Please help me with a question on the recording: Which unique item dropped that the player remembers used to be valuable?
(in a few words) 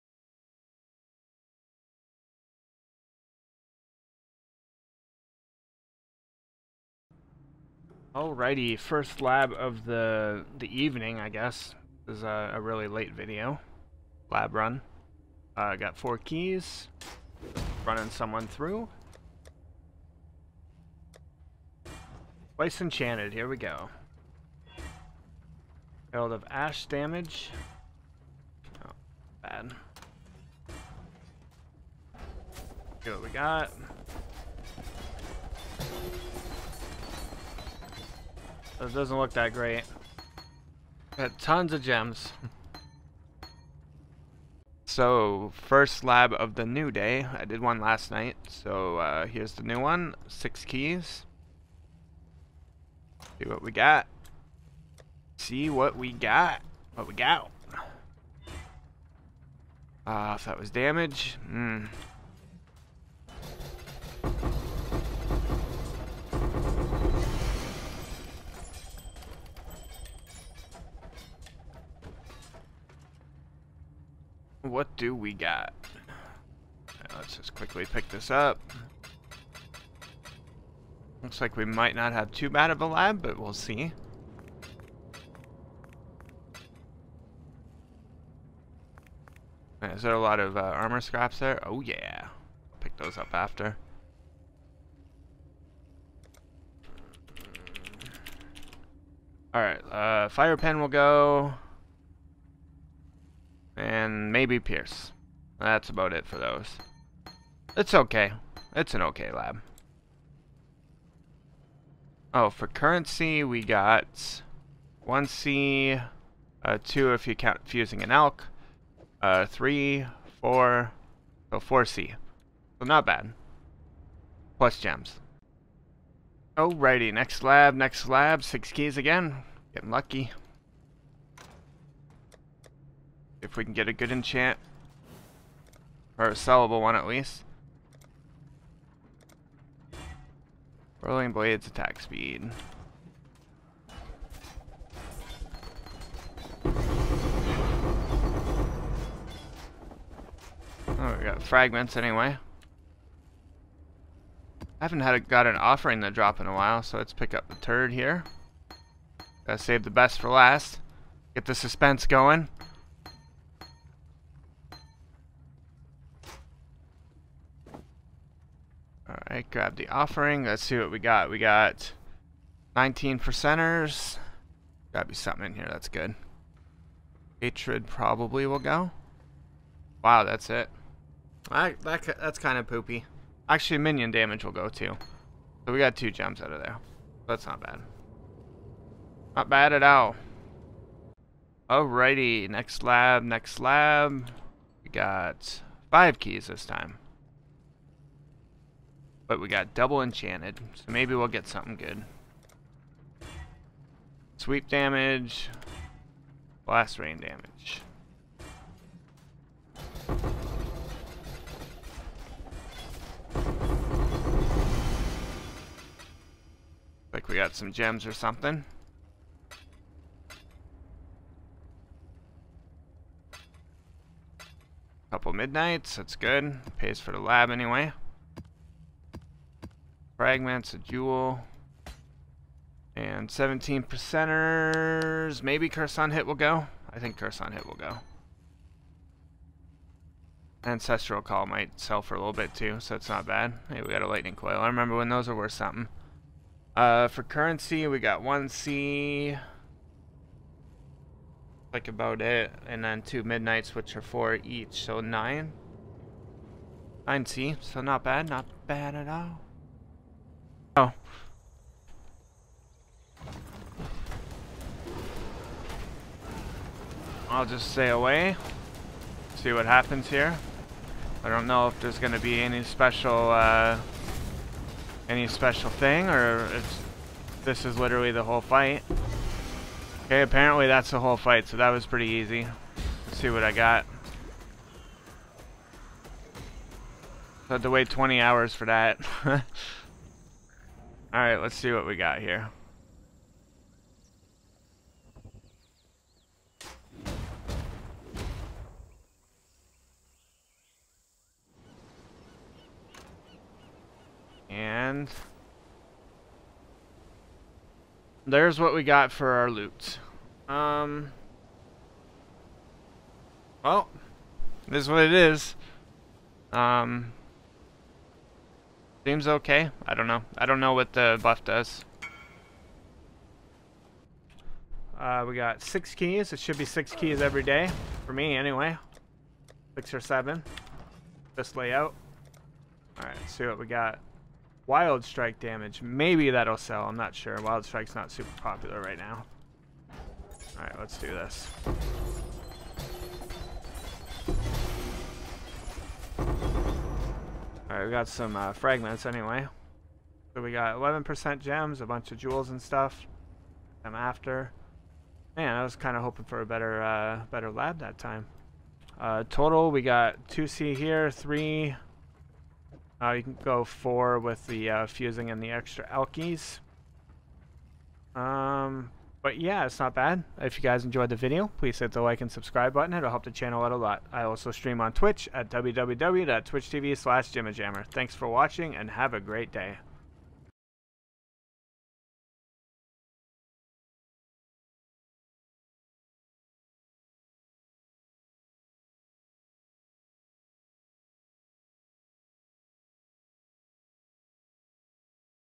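Lightning Coil.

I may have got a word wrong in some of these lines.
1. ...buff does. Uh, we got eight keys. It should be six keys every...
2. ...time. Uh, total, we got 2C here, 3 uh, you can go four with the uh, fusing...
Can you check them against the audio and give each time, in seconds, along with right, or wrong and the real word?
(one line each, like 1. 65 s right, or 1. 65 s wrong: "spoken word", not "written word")
1. 321 s wrong: "six", not "eight"
2. 357 s right.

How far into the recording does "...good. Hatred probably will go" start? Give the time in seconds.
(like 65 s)
175 s.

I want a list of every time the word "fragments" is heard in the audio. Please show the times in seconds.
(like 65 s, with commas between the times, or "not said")
151 s, 230 s, 348 s.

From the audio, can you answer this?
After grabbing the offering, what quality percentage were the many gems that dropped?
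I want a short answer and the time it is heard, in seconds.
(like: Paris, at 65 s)
19 percent, at 172 s.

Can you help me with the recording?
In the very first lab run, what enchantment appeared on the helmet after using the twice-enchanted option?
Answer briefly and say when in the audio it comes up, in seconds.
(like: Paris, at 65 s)
Herald of Ash damage, at 26 s.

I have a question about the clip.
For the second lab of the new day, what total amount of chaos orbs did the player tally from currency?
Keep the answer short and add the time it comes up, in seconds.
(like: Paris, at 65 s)
4C, at 121 s.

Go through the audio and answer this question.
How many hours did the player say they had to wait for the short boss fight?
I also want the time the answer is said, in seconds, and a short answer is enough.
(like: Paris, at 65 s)
20, at 287 s.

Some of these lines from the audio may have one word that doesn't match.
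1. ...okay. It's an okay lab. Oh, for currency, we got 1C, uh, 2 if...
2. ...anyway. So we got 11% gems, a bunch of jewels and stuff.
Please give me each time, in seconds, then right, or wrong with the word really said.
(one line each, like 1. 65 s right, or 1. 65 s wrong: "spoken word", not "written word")
1. 107 s right
2. 349 s right.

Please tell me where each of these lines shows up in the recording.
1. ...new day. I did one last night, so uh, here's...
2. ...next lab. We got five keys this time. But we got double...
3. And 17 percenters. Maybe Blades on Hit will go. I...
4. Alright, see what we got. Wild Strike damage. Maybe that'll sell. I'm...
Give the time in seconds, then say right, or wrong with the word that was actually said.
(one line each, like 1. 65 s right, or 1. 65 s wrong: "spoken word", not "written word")
1. 46 s right
2. 193 s right
3. 232 s wrong: "Curse", not "Blades"
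4. 332 s right.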